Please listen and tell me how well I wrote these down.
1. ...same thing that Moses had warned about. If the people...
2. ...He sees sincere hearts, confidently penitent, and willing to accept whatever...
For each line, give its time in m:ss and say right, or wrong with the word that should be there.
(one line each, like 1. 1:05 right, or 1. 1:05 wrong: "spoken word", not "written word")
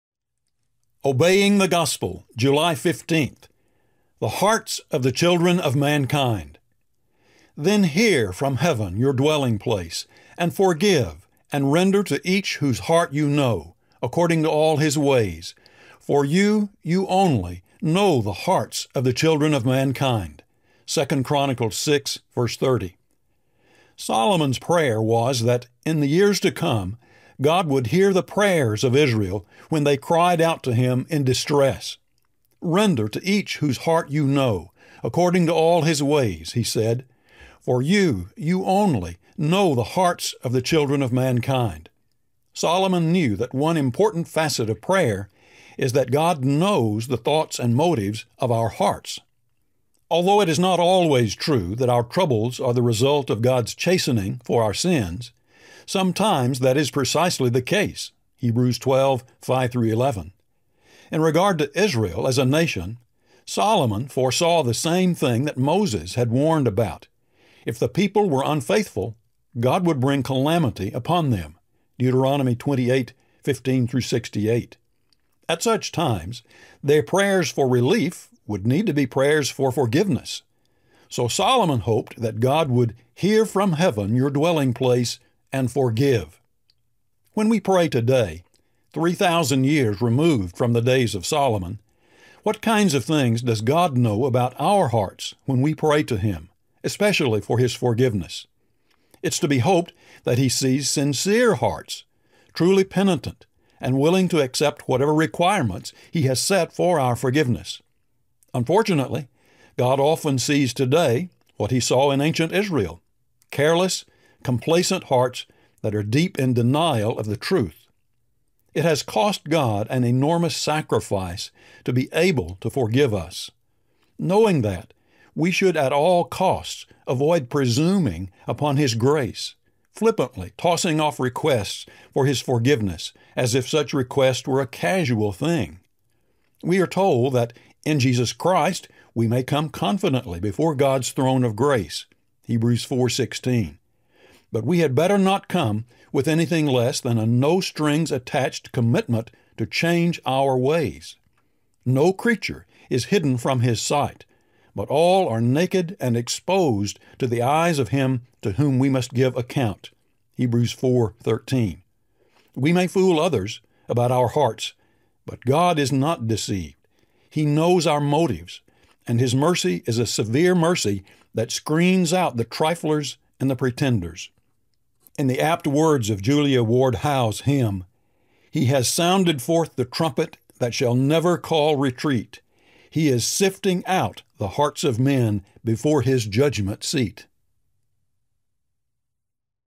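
1. 1:04 right
2. 1:40 wrong: "truly", not "confidently".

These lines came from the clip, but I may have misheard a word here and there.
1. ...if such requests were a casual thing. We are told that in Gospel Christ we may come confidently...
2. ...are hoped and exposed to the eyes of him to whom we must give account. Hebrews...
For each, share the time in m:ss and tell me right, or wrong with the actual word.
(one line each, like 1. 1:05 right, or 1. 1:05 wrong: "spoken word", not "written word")
1. 2:13 wrong: "Jesus", not "Gospel"
2. 2:35 wrong: "naked", not "hoped".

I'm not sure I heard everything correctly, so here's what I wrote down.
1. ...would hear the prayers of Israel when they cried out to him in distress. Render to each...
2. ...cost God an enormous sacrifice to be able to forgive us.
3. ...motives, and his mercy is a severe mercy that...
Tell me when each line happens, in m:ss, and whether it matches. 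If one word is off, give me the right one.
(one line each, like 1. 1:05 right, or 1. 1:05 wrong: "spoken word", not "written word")
1. 0:27 right
2. 1:59 right
3. 2:48 right.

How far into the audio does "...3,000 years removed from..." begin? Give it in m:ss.
1:28.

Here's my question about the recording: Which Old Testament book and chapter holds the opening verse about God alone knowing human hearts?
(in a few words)
2 Chronicles 6.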